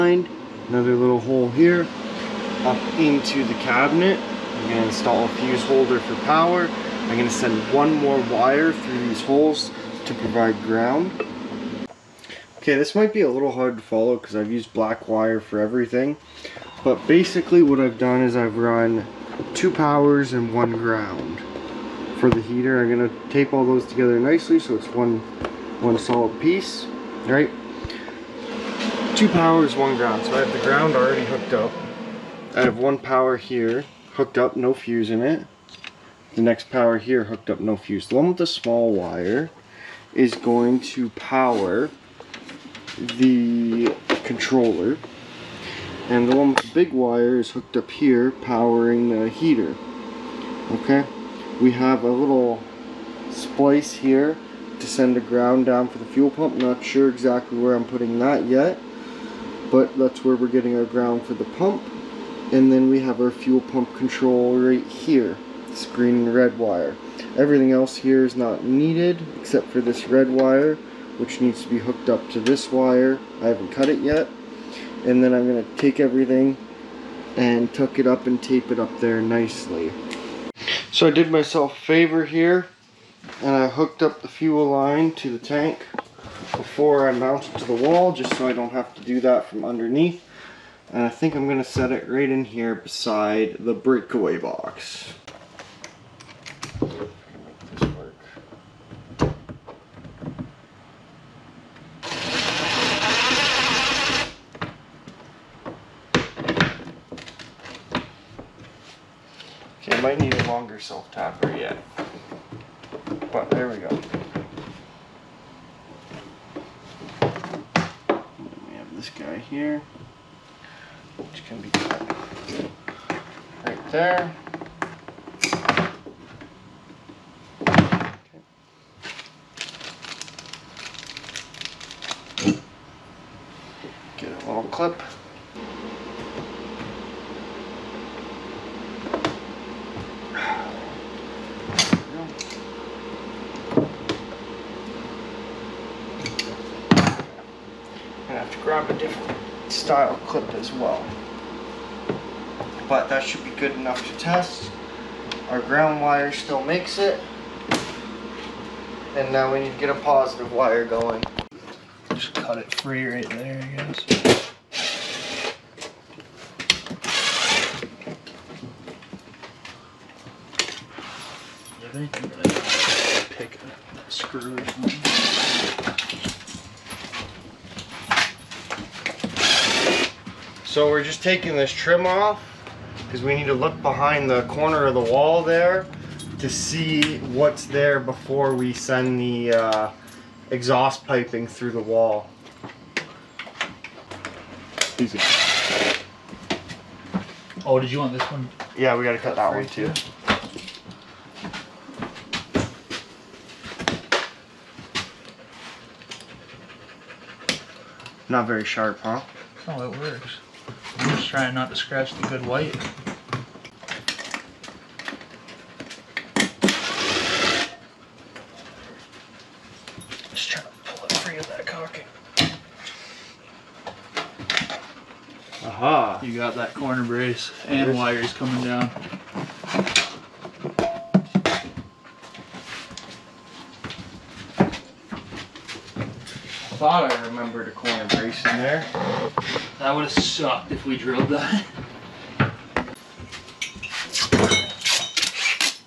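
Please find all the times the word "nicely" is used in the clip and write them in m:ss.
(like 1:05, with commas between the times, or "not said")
0:24, 1:19.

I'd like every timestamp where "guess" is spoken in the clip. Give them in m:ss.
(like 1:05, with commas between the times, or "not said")
2:43.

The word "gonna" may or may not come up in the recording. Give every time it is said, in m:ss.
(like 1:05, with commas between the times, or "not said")
1:31, 2:14, 2:52.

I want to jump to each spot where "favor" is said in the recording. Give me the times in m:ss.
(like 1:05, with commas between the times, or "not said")
1:21.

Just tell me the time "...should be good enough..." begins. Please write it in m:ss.
2:33.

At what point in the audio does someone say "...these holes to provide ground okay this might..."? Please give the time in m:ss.
0:09.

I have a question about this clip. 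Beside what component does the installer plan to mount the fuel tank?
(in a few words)
breakaway box.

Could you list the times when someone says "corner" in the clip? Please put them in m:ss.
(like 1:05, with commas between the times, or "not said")
3:04, 3:46, 3:57.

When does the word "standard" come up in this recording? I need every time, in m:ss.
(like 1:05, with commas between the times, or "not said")
not said.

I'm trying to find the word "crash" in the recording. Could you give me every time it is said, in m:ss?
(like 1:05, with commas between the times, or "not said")
not said.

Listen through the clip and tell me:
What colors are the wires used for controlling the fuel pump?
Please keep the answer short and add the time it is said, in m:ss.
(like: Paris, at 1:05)
green and red, at 1:05.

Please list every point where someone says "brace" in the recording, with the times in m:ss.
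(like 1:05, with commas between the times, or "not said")
3:47, 3:58.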